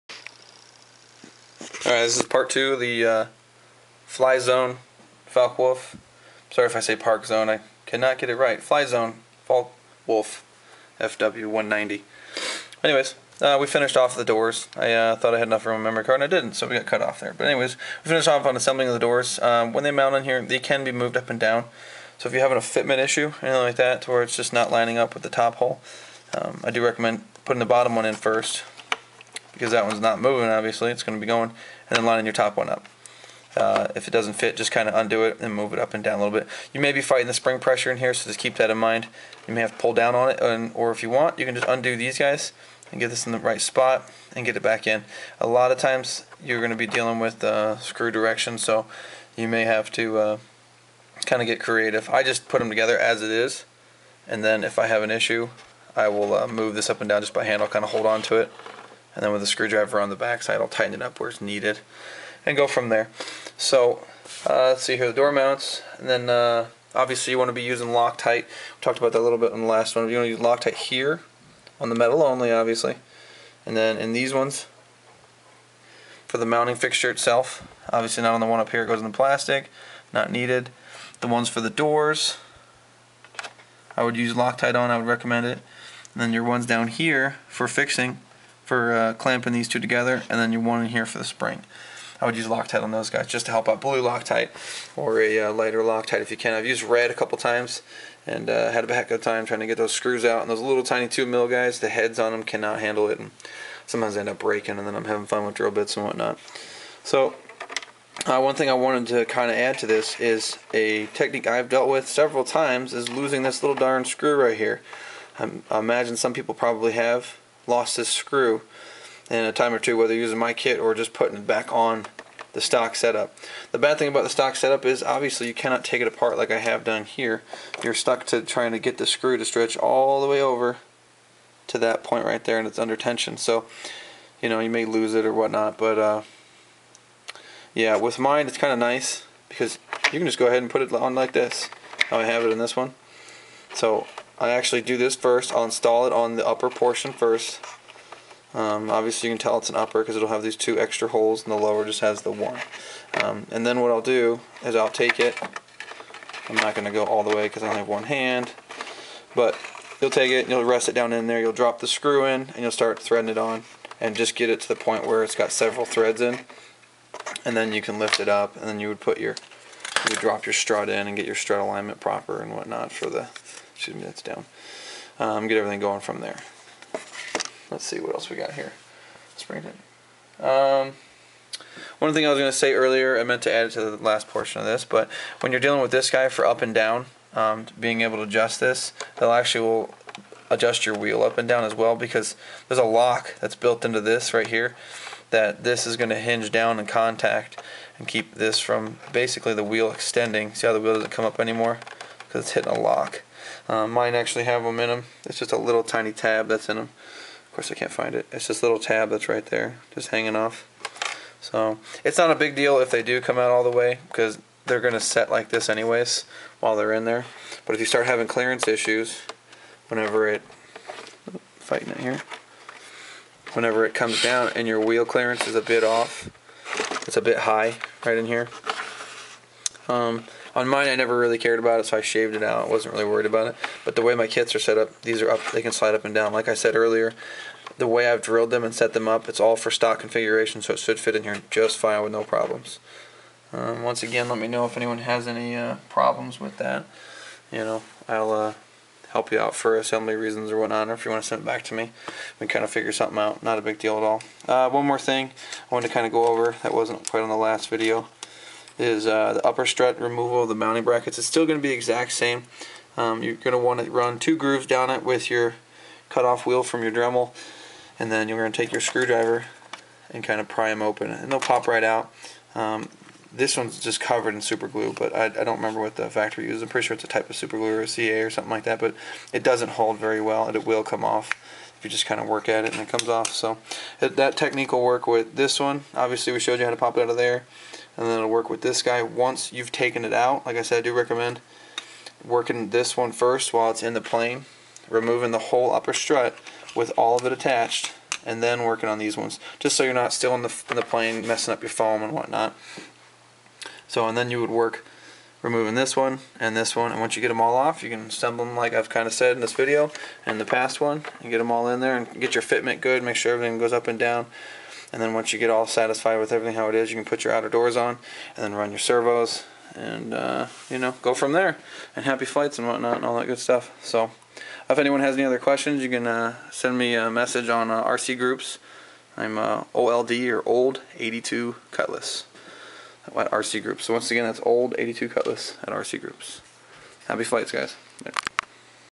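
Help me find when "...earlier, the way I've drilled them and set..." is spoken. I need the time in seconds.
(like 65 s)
236 s.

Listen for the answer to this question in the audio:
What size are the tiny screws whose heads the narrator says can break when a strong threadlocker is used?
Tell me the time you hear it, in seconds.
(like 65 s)
101 s.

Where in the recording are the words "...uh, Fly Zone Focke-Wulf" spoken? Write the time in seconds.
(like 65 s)
3 s.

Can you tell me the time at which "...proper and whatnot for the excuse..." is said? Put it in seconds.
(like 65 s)
171 s.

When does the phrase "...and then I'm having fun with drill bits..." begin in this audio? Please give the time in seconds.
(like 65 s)
104 s.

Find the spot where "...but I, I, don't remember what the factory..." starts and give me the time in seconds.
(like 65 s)
274 s.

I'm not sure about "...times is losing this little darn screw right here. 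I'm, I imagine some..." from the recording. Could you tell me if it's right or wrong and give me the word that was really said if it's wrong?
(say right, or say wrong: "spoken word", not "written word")
right.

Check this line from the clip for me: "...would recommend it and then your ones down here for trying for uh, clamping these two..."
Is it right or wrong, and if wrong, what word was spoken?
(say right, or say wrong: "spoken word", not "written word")
wrong: "fixing", not "trying".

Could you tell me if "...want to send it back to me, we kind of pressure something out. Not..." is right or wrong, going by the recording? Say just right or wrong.
wrong.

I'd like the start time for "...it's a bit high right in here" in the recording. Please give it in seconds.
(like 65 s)
227 s.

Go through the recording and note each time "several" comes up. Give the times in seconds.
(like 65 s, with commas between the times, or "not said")
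112 s, 165 s.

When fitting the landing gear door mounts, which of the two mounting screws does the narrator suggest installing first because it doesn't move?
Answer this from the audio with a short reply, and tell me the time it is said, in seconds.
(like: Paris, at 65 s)
The bottom one, at 27 s.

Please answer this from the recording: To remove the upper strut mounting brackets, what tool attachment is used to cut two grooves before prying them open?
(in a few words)
Cutoff wheel.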